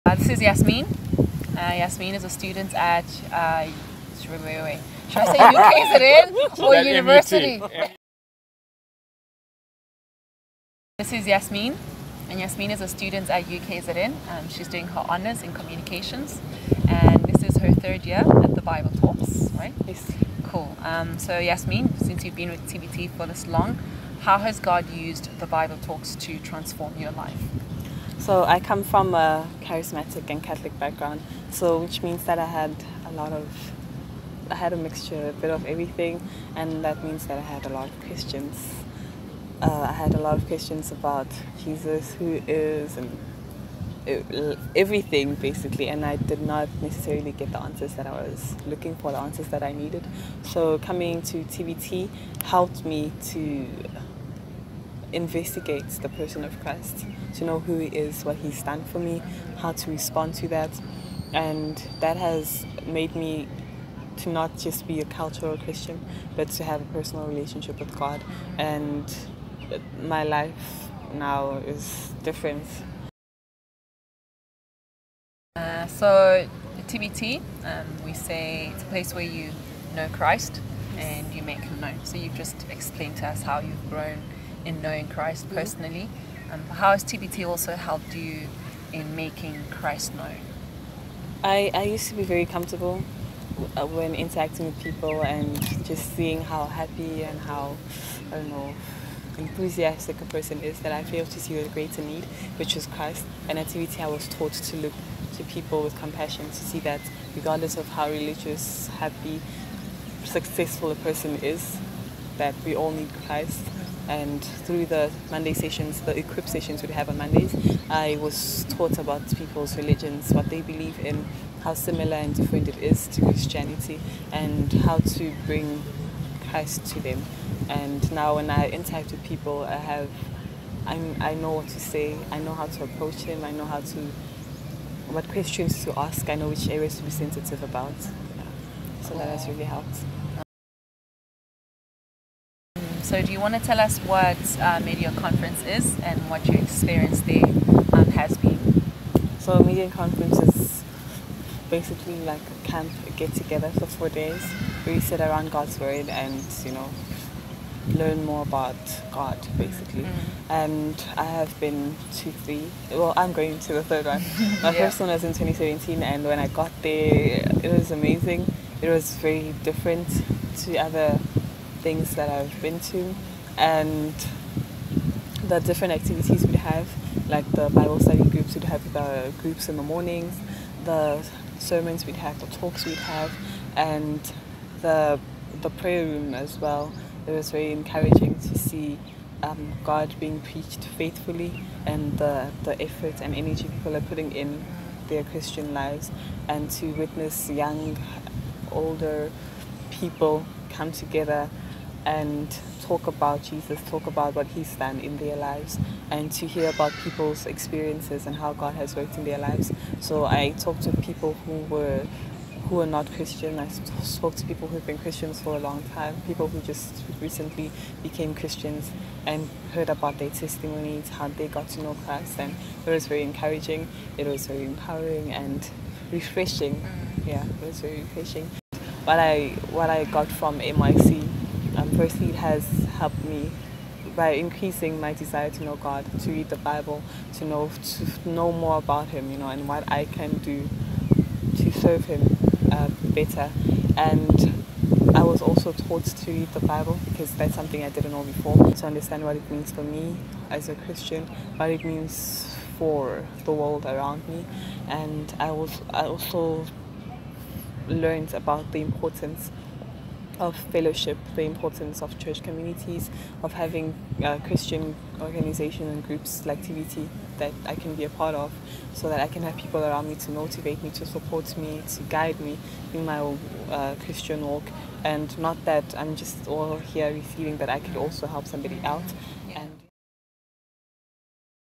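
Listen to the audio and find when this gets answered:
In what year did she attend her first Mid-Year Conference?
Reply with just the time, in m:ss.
2:45.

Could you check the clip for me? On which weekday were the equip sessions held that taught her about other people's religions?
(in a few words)
Monday.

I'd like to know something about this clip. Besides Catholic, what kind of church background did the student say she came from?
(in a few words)
Charismatic.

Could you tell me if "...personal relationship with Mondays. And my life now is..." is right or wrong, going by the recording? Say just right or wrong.
wrong.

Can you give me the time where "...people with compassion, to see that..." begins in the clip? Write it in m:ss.
1:45.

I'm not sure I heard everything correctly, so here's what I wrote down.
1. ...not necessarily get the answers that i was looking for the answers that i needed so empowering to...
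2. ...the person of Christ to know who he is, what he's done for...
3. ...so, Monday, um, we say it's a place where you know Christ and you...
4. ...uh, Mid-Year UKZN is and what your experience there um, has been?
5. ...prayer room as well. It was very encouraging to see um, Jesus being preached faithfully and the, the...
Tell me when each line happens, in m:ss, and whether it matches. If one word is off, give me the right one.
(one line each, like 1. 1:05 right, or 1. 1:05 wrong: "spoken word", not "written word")
1. 0:46 wrong: "coming", not "empowering"
2. 0:55 right
3. 1:15 wrong: "TBT", not "Monday"
4. 2:24 wrong: "Conference", not "UKZN"
5. 3:05 wrong: "God", not "Jesus".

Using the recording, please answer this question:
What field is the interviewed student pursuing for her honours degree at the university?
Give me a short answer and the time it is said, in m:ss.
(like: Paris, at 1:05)
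Communications, at 0:15.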